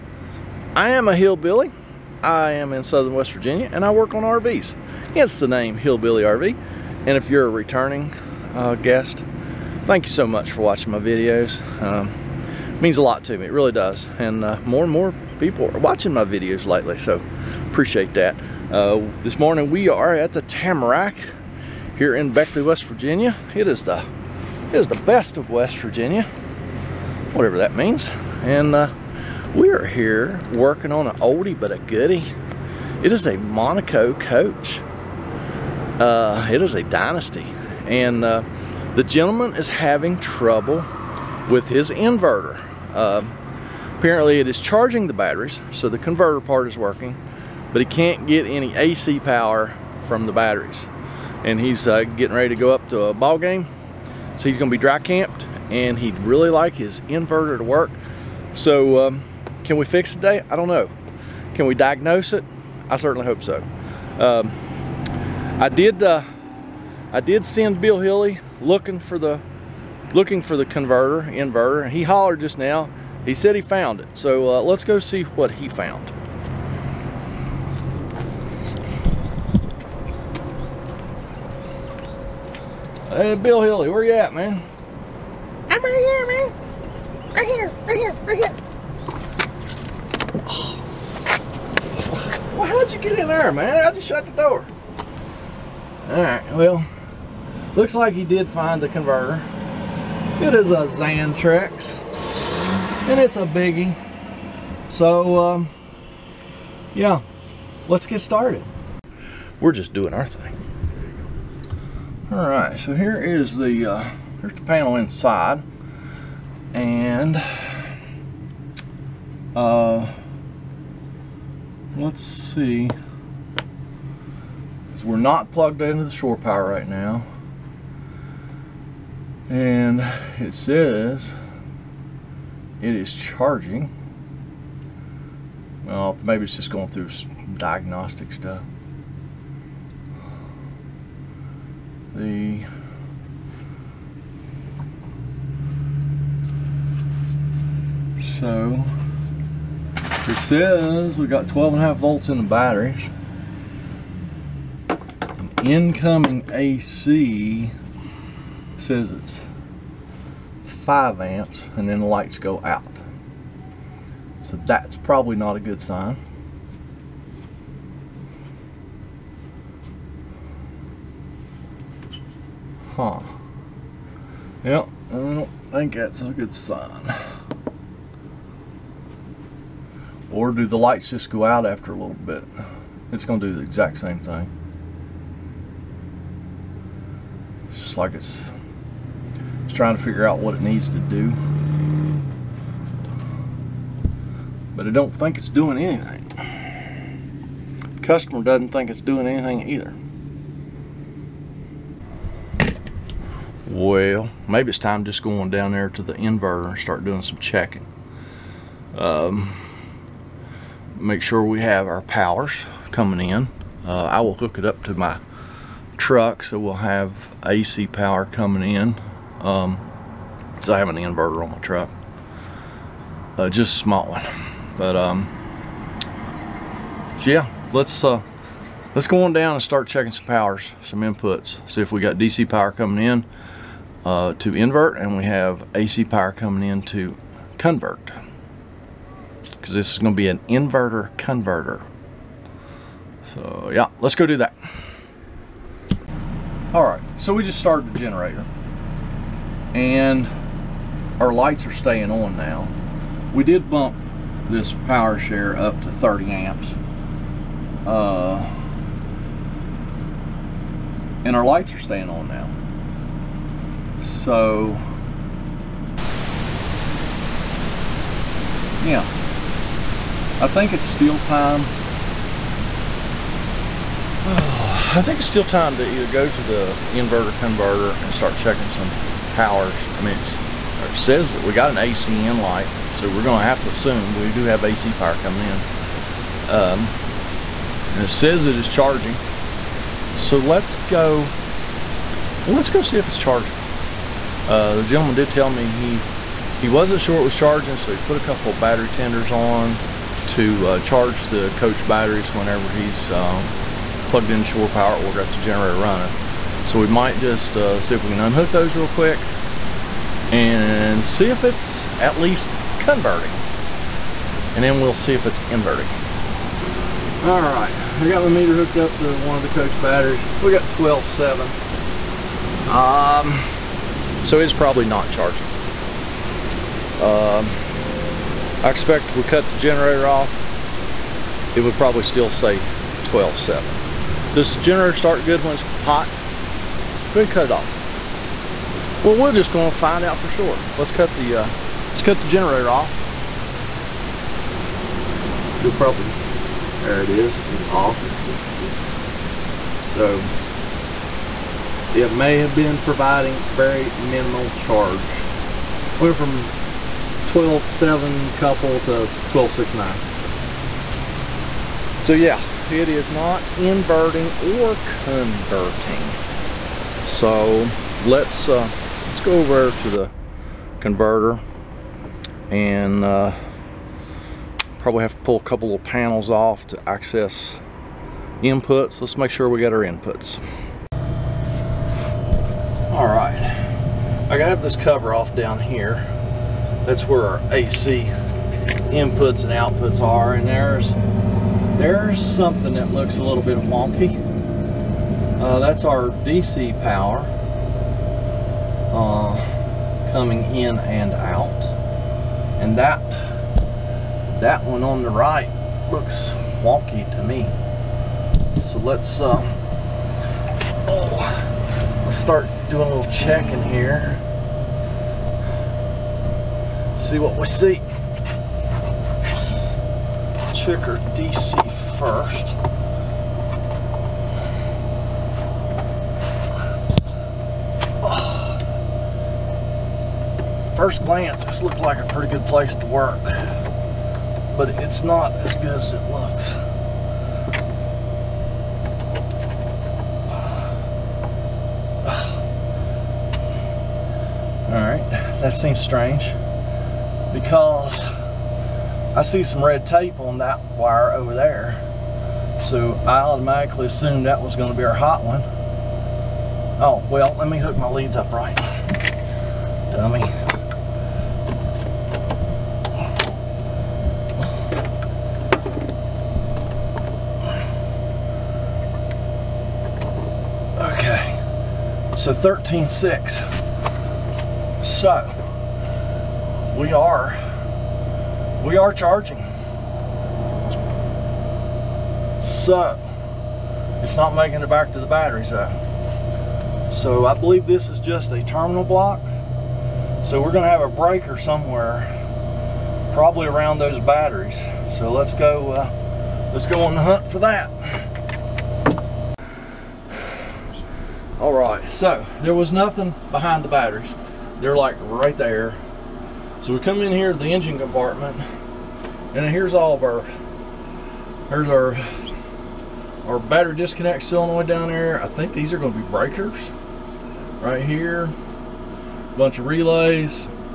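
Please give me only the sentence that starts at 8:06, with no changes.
So I believe this is just a terminal block.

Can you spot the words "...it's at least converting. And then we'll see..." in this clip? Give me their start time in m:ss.
5:11.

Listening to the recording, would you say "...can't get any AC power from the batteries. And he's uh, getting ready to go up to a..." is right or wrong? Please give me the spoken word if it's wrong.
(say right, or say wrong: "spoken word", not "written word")
right.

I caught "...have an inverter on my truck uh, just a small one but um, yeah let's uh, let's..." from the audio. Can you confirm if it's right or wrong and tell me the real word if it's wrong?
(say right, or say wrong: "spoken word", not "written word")
right.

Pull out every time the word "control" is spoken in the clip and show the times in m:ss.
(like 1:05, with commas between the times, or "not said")
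not said.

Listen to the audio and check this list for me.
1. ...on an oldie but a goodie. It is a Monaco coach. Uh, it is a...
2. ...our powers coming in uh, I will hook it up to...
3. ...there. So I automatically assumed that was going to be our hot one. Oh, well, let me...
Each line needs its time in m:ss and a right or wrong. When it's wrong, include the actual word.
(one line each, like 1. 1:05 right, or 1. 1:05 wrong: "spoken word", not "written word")
1. 0:30 right
2. 3:31 right
3. 7:31 right.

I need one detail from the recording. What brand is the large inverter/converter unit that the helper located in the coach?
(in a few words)
Xantrex.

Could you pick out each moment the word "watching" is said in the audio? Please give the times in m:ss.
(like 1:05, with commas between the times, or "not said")
0:10, 0:15.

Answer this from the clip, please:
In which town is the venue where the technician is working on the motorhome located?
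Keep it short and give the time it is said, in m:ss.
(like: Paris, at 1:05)
Beckley, West Virginia, at 0:22.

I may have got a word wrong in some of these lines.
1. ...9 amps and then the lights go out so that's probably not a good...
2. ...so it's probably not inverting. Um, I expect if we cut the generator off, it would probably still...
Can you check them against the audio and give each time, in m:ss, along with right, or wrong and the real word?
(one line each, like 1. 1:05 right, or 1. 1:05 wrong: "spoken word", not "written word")
1. 2:40 wrong: "5", not "9"
2. 5:24 wrong: "charging", not "inverting".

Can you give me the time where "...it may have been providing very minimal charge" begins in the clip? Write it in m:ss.
5:51.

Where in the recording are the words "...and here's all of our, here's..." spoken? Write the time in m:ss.
8:29.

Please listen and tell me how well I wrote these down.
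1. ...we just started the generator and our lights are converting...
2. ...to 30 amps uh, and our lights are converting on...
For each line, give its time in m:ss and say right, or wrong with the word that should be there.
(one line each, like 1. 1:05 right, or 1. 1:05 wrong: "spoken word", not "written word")
1. 4:07 wrong: "staying", not "converting"
2. 4:15 wrong: "staying", not "converting".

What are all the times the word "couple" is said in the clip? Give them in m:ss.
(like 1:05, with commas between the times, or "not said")
4:58, 5:58, 6:15.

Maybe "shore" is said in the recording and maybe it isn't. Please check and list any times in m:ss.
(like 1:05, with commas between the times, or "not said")
2:06, 5:04.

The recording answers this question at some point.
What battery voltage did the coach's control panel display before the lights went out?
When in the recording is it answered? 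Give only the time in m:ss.
2:31.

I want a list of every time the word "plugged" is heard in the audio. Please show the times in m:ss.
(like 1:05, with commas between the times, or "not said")
2:05, 5:04.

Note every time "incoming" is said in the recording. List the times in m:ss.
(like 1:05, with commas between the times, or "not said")
2:35.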